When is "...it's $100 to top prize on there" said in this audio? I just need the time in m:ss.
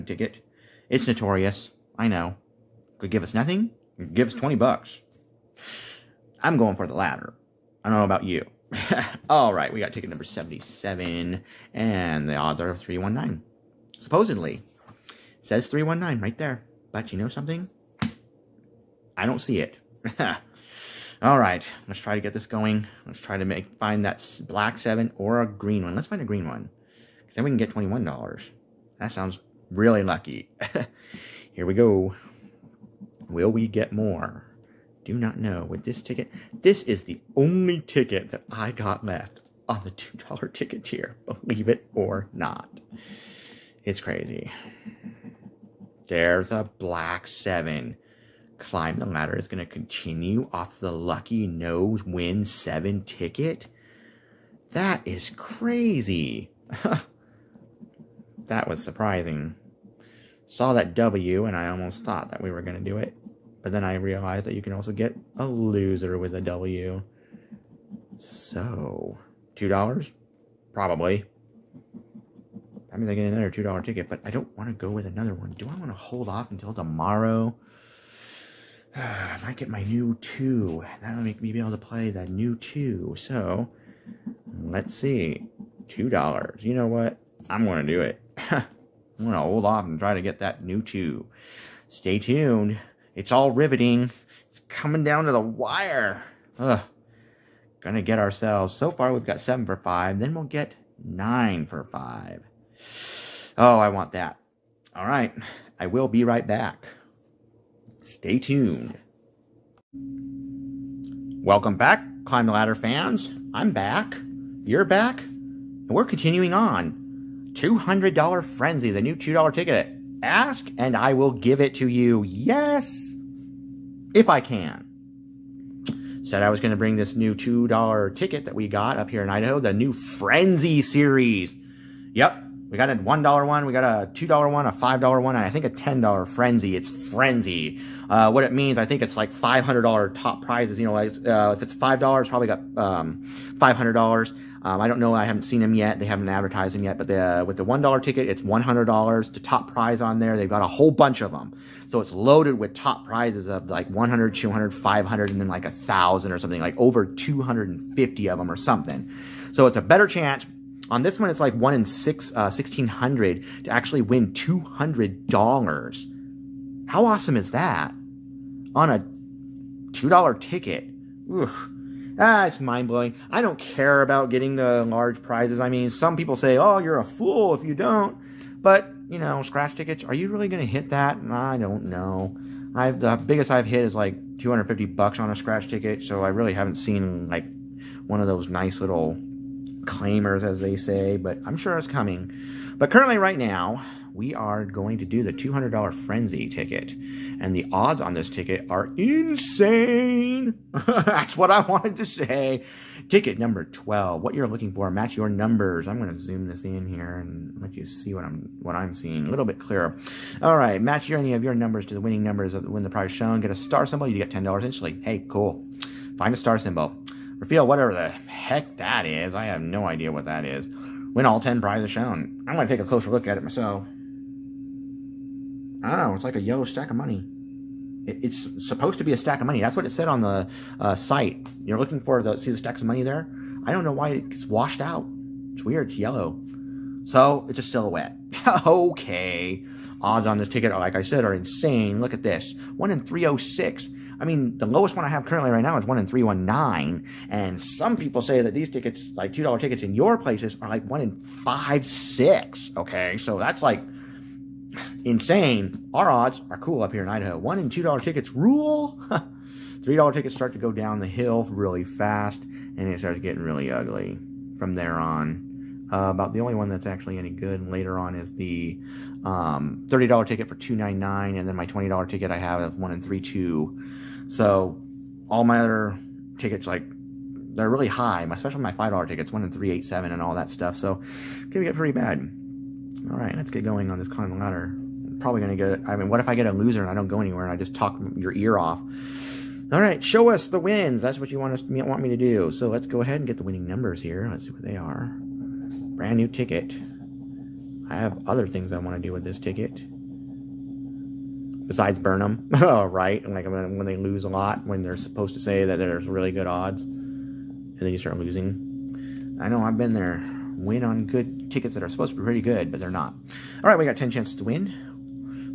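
2:28.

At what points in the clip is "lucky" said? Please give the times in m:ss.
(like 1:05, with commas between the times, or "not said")
0:30, 0:50.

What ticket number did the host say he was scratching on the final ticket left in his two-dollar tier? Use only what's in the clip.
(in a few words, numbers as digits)
77.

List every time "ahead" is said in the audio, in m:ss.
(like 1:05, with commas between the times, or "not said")
4:53.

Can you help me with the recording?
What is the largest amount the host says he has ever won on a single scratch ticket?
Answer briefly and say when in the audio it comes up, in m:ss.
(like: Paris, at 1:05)
$250, at 3:04.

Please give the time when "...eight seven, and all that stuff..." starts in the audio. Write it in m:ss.
4:39.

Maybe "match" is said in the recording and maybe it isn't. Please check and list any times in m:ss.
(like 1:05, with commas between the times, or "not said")
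3:24, 3:30.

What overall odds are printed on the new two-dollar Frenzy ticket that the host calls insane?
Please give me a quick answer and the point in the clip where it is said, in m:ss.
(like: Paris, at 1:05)
1 in 306, at 4:02.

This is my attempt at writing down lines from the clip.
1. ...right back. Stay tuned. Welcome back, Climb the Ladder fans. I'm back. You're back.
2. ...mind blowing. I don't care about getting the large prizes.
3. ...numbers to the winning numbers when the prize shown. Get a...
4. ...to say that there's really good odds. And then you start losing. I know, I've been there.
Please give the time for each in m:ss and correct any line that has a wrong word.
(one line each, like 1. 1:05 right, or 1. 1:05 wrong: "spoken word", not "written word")
1. 1:46 right
2. 2:52 right
3. 3:31 right
4. 5:05 right.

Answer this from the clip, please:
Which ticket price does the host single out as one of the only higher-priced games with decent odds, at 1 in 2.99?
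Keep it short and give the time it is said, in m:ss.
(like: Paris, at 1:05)
$30, at 4:29.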